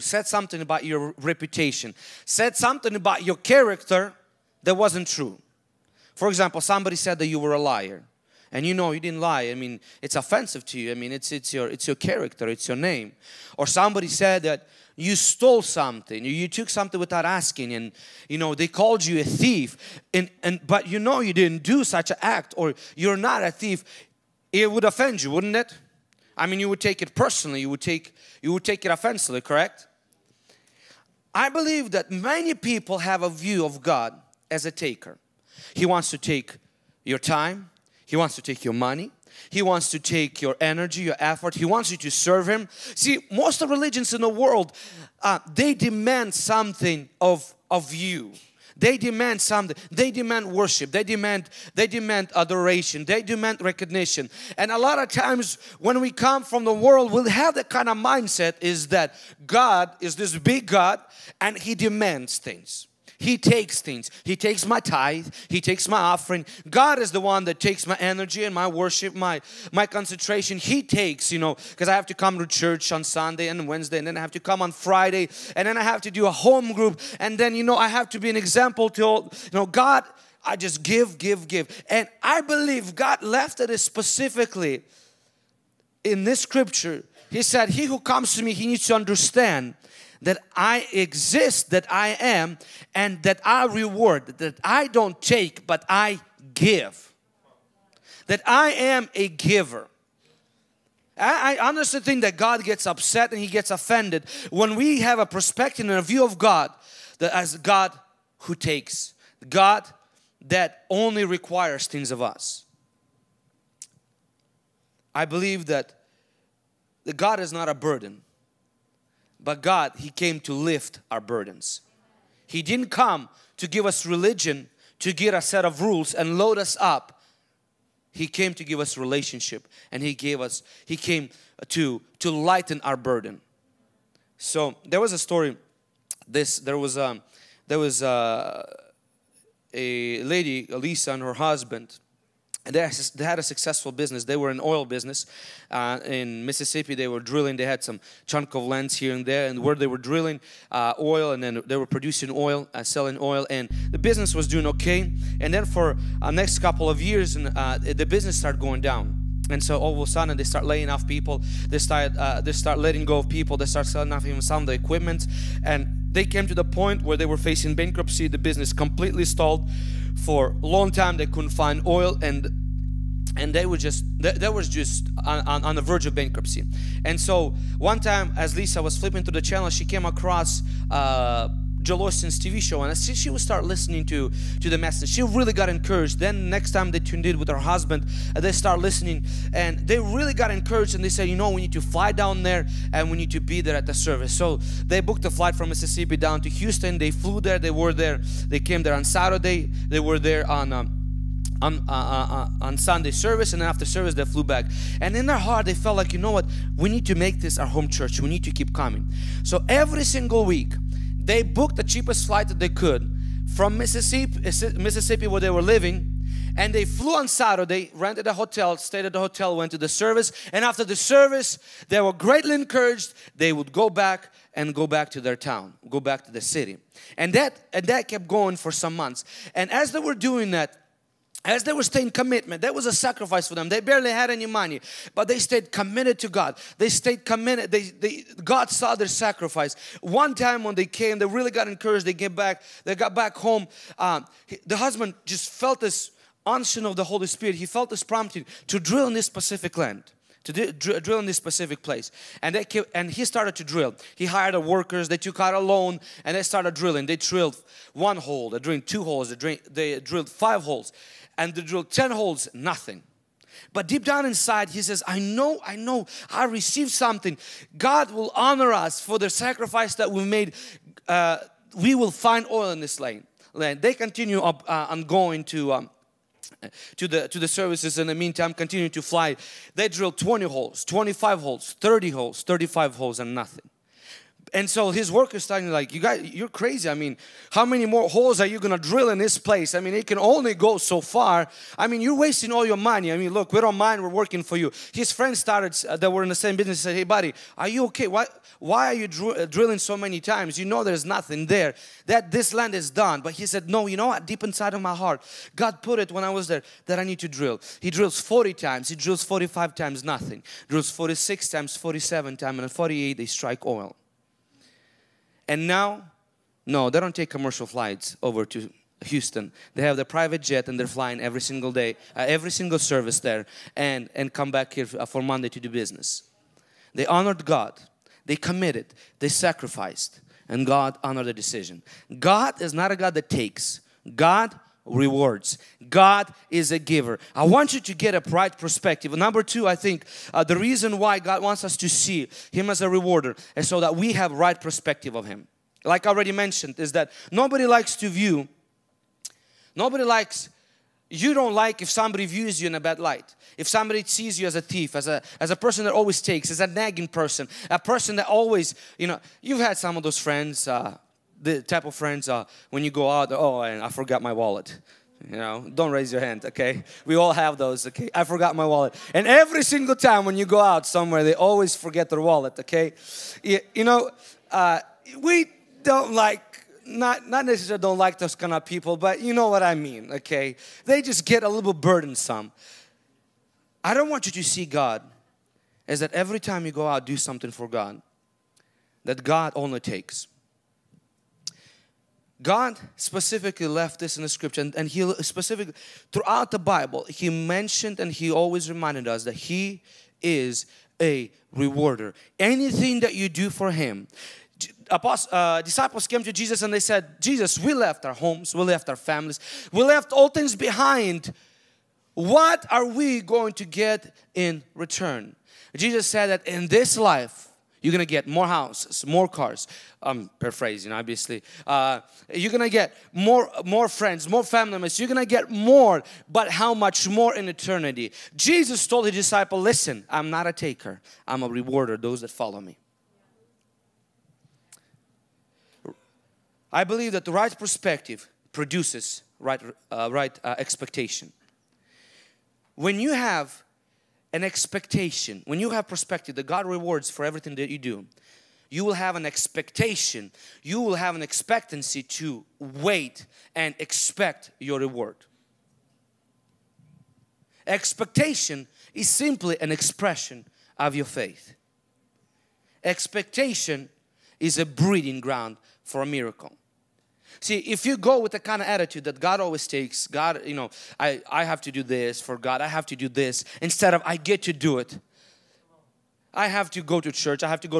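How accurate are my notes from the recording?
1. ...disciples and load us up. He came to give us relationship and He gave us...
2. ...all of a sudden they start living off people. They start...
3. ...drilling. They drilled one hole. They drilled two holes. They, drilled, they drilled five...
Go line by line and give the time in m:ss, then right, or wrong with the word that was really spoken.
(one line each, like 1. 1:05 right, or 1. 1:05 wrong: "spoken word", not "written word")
1. 2:05 wrong: "rules", not "disciples"
2. 2:39 wrong: "laying", not "living"
3. 4:16 right.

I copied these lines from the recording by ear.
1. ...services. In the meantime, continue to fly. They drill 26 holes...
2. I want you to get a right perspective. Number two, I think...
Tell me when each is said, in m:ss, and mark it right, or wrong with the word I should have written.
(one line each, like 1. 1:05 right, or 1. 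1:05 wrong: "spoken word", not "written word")
1. 4:37 wrong: "20", not "26"
2. 5:37 right.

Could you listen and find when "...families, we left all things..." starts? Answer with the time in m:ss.
6:48.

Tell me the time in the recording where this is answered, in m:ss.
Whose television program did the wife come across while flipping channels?
3:01.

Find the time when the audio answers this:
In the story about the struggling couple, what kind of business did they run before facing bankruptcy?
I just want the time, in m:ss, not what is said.
2:24.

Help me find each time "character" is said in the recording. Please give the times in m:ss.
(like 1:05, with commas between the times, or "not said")
0:03, 0:11.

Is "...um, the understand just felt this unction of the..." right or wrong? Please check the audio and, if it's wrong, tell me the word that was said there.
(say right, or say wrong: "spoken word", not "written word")
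wrong: "husband", not "understand".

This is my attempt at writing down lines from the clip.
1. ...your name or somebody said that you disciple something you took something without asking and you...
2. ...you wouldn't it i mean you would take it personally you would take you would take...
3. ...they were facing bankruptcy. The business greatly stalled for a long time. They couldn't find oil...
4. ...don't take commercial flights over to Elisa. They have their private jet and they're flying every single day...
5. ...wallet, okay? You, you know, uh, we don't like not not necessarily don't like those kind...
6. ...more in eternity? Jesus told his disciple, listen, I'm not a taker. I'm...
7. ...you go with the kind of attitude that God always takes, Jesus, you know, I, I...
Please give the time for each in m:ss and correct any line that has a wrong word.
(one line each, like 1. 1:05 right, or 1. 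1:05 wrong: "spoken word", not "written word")
1. 0:12 wrong: "stole", not "disciple"
2. 0:25 right
3. 2:47 wrong: "completely", not "greatly"
4. 5:17 wrong: "Houston", not "Elisa"
5. 6:12 right
6. 7:07 right
7. 7:47 wrong: "God", not "Jesus".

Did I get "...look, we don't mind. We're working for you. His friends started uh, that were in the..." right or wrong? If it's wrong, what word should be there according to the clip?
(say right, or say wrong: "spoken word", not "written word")
right.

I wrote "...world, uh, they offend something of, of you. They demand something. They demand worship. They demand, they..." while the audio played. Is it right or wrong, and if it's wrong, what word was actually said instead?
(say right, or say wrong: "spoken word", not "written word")
wrong: "demand", not "offend".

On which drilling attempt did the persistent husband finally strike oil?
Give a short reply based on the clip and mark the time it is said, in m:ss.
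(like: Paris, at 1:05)
48, at 5:12.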